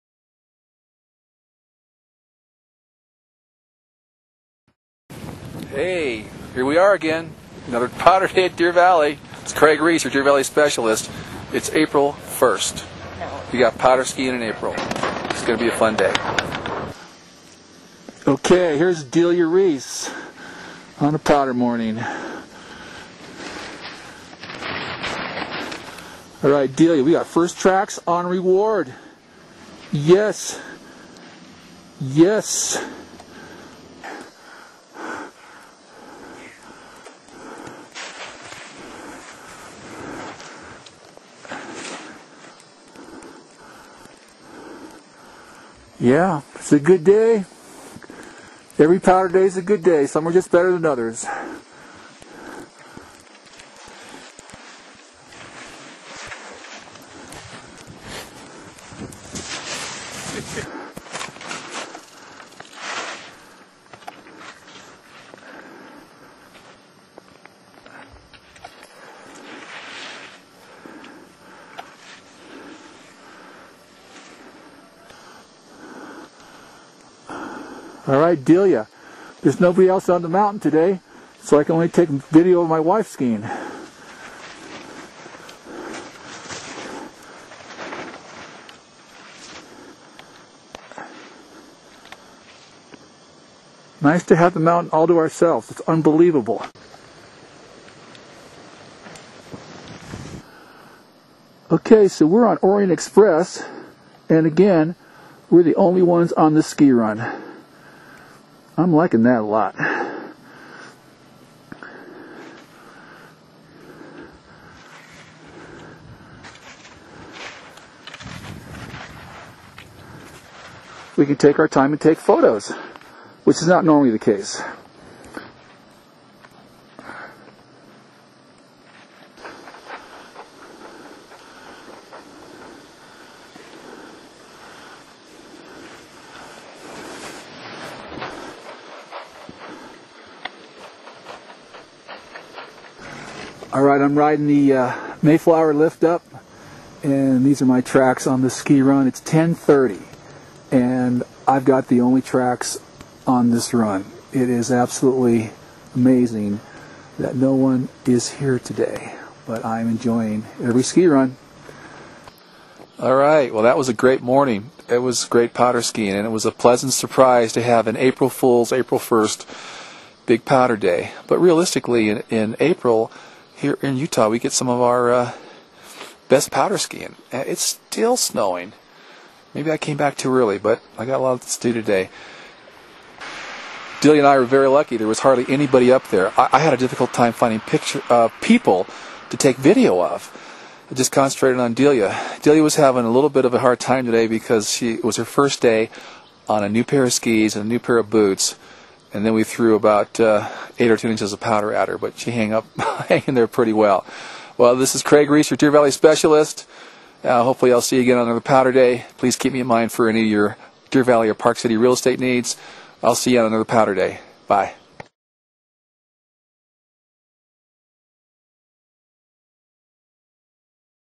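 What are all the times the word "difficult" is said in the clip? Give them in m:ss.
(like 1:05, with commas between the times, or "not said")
3:06.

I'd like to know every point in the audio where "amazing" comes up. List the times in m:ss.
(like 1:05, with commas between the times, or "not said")
2:35.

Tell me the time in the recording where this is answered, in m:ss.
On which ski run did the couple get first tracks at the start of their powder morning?
0:28.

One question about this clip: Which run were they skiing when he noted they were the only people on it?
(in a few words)
Orient Express.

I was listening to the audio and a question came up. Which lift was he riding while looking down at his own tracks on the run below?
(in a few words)
Mayflower.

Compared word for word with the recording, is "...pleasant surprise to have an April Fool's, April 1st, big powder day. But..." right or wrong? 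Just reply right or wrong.
right.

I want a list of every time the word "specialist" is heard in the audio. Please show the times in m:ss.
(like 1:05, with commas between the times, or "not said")
0:10, 3:25.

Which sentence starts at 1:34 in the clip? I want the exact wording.
Nice to have the mountain all to ourselves.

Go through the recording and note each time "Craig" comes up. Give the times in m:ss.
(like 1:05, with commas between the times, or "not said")
0:09, 3:25.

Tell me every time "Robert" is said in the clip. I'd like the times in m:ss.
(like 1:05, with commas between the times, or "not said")
not said.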